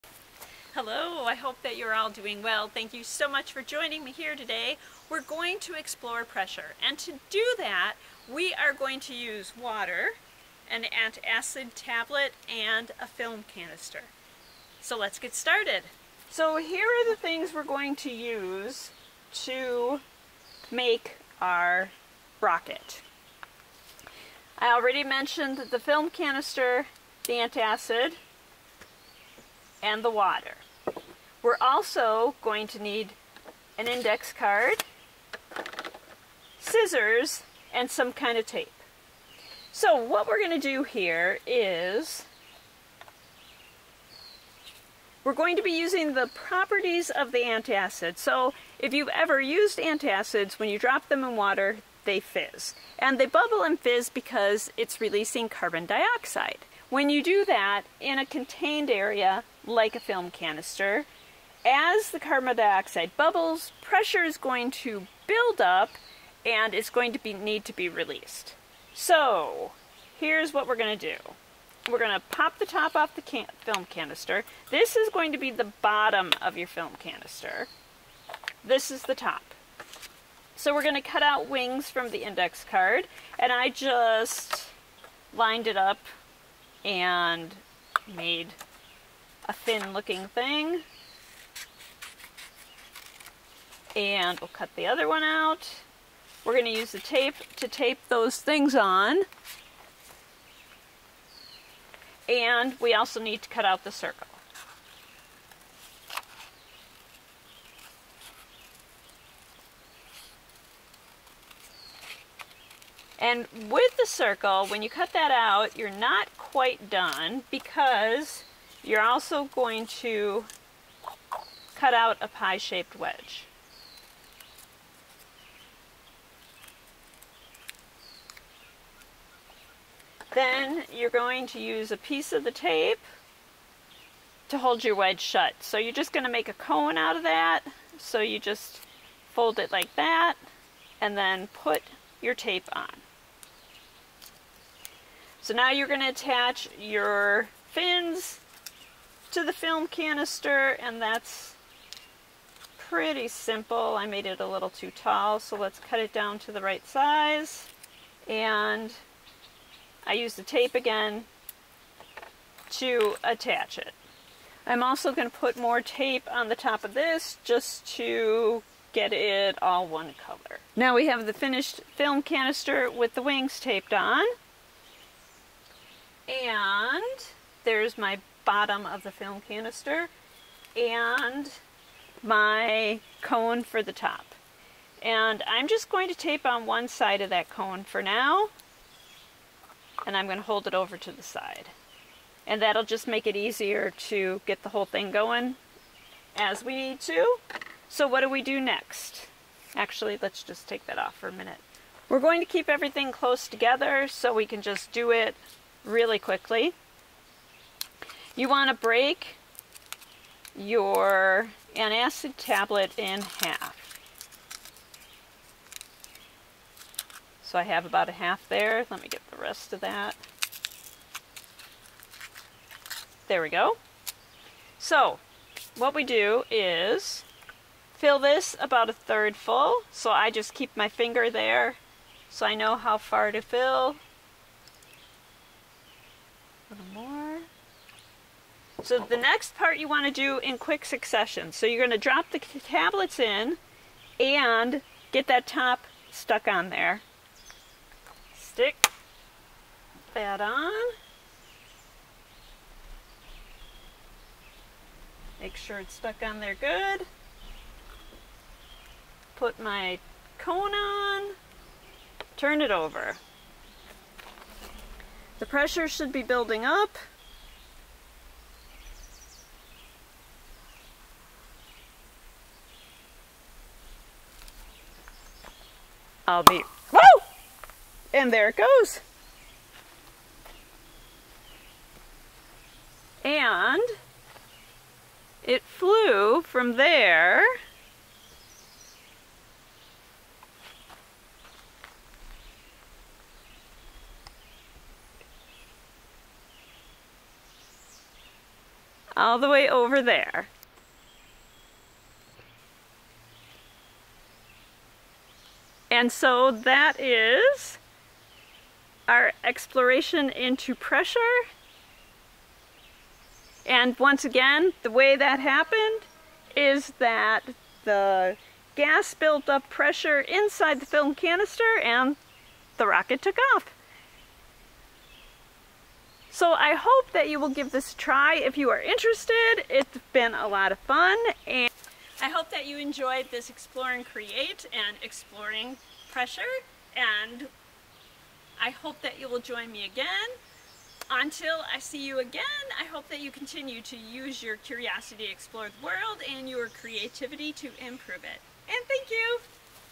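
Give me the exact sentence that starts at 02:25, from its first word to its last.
So now you're going to attach your fins to the film canister and that's pretty simple.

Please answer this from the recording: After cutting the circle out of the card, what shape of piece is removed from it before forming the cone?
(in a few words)
pie-shaped wedge.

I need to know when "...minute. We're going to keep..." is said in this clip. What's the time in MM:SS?
03:21.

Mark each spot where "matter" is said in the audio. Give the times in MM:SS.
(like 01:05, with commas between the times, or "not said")
not said.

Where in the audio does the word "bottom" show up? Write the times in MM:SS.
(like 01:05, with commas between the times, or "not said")
01:15, 02:58.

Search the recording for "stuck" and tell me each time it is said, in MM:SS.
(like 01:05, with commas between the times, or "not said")
04:06, 04:15.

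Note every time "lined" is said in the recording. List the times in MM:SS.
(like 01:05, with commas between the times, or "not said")
01:25.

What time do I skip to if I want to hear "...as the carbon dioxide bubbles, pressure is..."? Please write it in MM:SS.
01:01.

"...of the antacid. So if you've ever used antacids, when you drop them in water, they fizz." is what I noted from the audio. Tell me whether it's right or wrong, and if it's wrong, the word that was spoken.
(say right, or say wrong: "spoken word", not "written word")
right.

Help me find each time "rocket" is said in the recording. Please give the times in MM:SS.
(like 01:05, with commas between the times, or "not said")
00:22, 05:22.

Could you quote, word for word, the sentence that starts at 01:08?
So here's what we're going to do.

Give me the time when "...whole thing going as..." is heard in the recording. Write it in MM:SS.
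03:14.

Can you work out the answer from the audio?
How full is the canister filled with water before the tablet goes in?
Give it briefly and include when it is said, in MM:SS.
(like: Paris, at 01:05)
a third full, at 03:48.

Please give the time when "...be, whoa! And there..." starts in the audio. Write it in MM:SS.
04:36.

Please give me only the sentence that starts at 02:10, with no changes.
Then you're going to use a piece of the tape to hold your wedge shut.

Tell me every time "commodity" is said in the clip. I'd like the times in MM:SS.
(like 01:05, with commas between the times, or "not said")
not said.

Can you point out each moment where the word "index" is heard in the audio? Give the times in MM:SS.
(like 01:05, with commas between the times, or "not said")
00:33, 01:22.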